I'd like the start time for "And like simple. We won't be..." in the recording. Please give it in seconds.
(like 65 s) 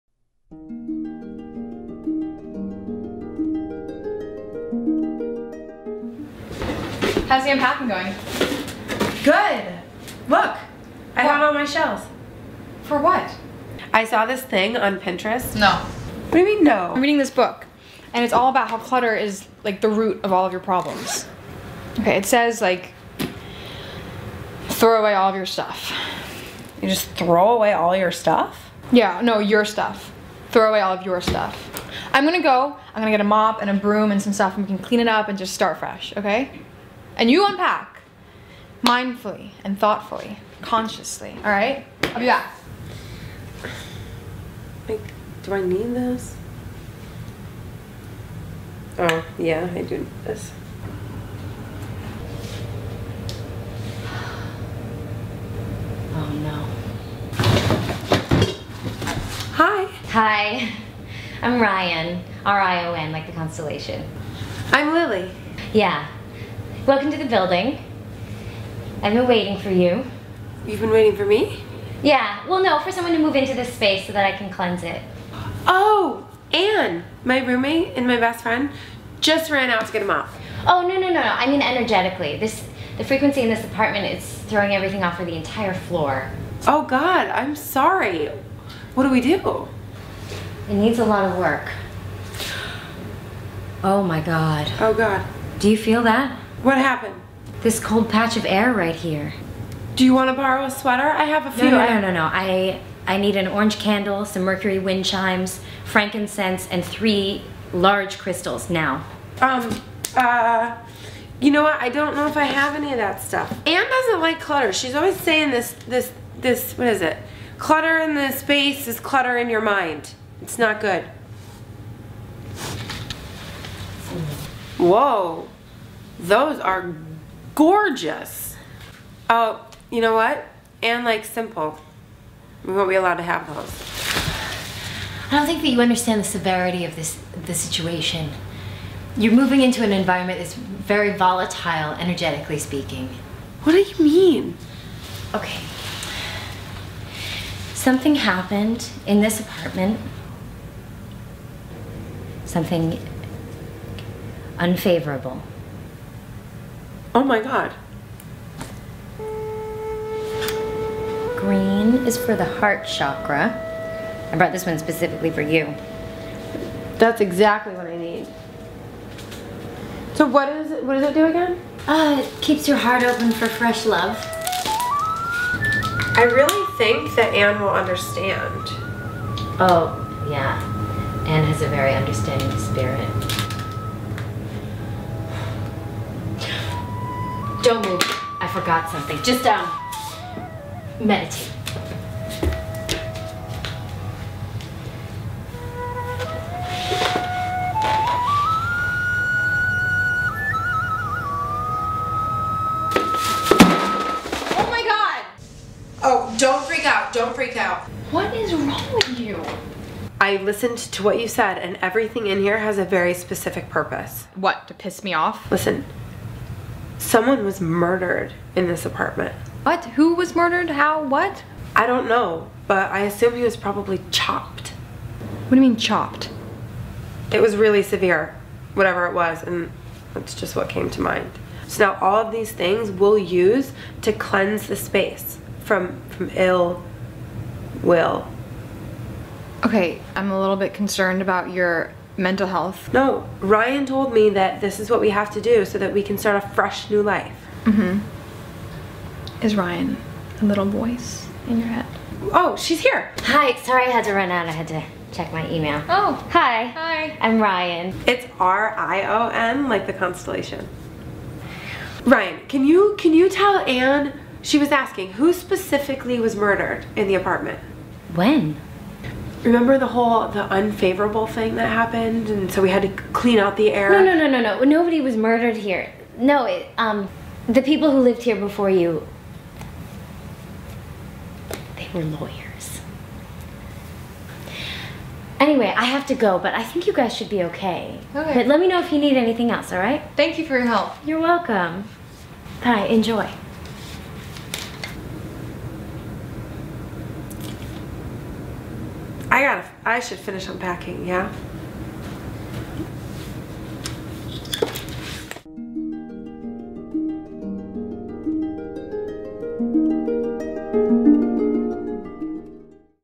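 130 s.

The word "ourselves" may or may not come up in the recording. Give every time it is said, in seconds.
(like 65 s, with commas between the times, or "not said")
not said.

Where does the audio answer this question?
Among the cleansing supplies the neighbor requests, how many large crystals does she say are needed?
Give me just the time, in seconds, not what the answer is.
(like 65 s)
106 s.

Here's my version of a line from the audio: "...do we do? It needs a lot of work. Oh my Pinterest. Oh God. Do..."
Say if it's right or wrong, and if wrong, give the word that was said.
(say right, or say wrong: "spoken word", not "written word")
wrong: "God", not "Pinterest".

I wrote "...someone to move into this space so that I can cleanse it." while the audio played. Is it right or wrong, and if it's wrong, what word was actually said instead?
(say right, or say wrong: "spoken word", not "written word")
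right.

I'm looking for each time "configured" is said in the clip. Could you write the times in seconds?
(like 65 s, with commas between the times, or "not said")
not said.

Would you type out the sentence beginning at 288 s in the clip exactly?
But let me know if you need anything else, all right?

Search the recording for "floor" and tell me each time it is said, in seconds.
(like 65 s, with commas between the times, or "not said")
85 s.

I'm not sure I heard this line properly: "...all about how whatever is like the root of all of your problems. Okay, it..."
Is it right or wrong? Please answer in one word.
wrong.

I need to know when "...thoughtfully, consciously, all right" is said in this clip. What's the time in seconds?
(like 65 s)
39 s.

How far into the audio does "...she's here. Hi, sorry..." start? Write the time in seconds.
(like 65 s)
252 s.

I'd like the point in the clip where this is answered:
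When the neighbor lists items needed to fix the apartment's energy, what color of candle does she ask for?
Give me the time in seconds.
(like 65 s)
103 s.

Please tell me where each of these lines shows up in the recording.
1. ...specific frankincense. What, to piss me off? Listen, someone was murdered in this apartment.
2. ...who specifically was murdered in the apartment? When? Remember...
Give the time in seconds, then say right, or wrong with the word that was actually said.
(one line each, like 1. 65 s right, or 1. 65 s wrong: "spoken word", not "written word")
1. 213 s wrong: "purpose", not "frankincense"
2. 265 s right.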